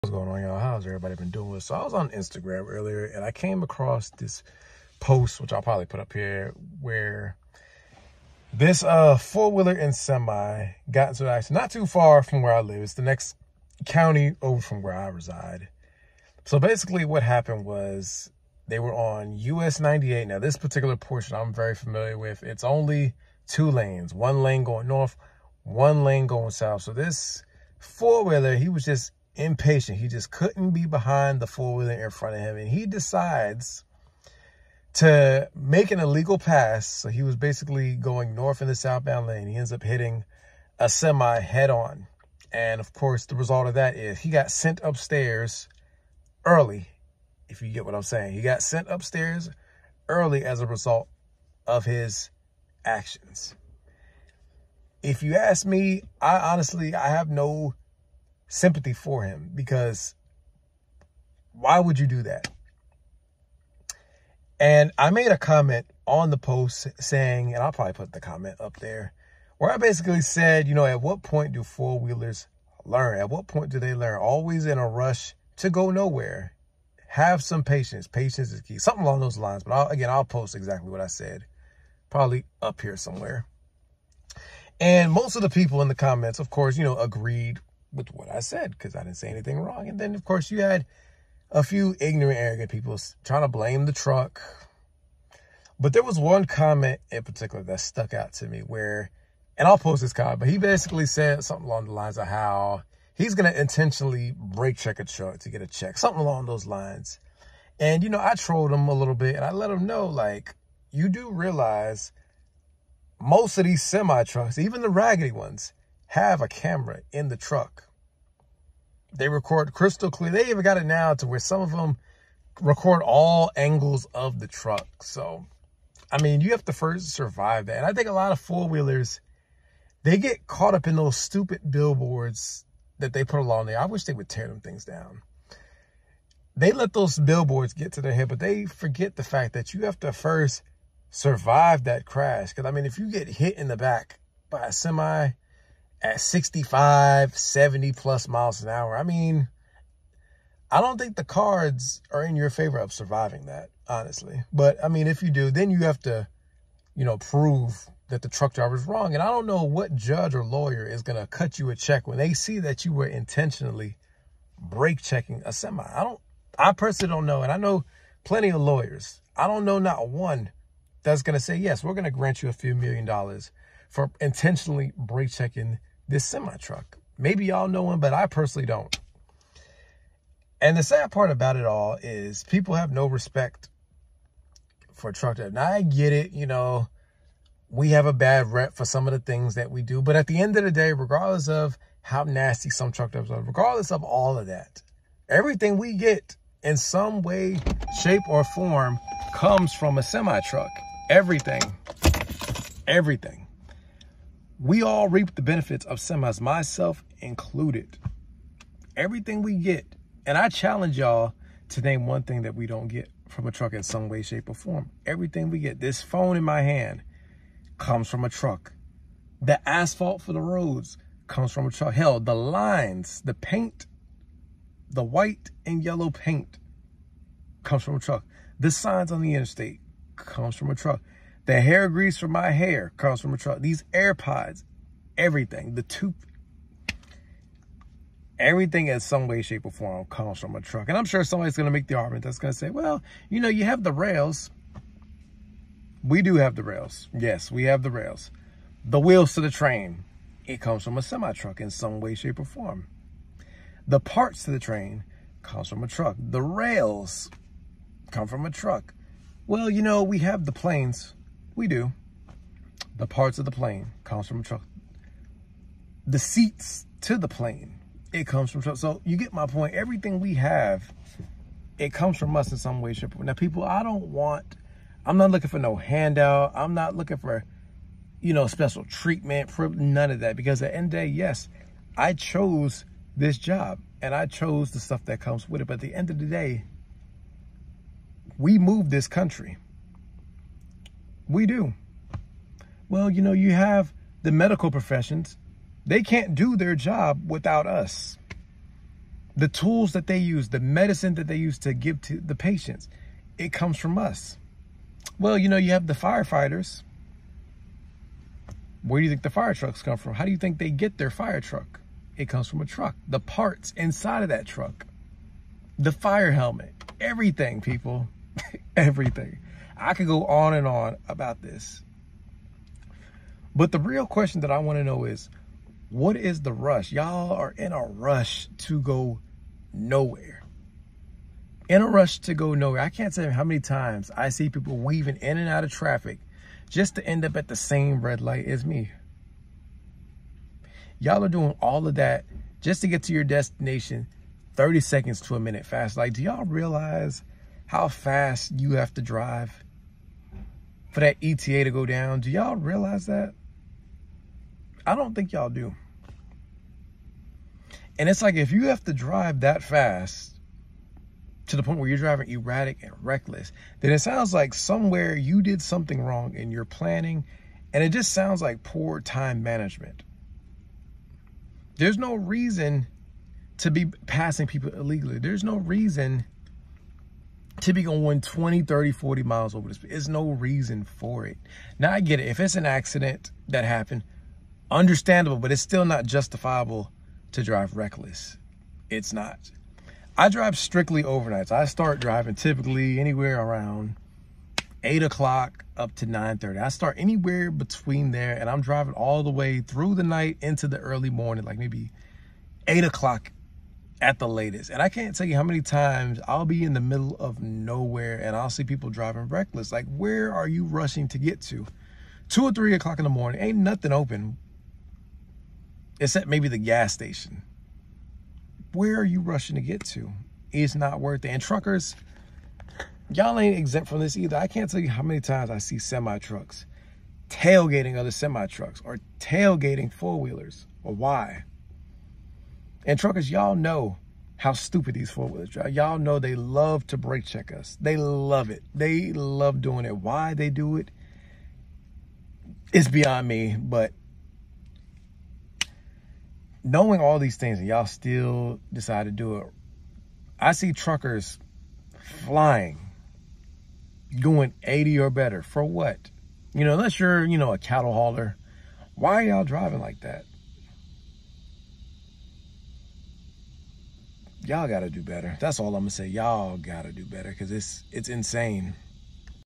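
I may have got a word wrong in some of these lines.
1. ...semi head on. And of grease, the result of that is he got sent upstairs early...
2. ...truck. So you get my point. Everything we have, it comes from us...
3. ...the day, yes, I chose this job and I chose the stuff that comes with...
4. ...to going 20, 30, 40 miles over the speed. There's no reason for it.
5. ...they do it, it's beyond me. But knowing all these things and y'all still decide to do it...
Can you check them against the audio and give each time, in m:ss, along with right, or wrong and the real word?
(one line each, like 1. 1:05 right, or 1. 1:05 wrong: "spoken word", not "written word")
1. 0:40 wrong: "course", not "grease"
2. 4:28 right
3. 4:40 right
4. 6:17 right
5. 7:20 right.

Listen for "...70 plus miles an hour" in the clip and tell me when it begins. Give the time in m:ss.
2:27.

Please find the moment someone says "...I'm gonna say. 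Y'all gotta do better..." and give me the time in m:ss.
7:45.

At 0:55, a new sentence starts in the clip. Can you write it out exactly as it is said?
If you ask me, I honestly, I have no sympathy for him because why would you do that?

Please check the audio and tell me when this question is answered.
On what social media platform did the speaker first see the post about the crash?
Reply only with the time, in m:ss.
0:02.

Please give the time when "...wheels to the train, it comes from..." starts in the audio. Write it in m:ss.
4:08.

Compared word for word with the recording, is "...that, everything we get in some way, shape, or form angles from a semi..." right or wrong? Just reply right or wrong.
wrong.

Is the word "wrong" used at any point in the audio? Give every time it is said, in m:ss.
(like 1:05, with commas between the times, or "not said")
1:29, 2:38, 6:06.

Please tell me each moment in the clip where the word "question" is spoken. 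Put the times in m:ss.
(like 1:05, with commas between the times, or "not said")
5:24.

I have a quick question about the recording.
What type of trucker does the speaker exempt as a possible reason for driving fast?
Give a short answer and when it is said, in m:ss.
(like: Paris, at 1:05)
Cattle hauler, at 7:37.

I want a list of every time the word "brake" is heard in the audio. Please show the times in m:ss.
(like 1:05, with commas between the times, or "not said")
1:44, 2:44, 2:54, 7:16.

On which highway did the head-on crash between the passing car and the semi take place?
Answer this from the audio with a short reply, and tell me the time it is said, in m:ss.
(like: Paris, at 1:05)
US 98, at 0:19.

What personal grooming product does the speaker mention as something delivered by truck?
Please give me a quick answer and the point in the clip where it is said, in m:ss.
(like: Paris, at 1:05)
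Hair grease, at 3:51.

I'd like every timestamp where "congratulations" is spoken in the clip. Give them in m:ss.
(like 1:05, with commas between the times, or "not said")
not said.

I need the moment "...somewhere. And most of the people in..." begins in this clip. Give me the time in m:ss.
1:22.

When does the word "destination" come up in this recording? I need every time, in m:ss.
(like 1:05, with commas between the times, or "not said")
5:43.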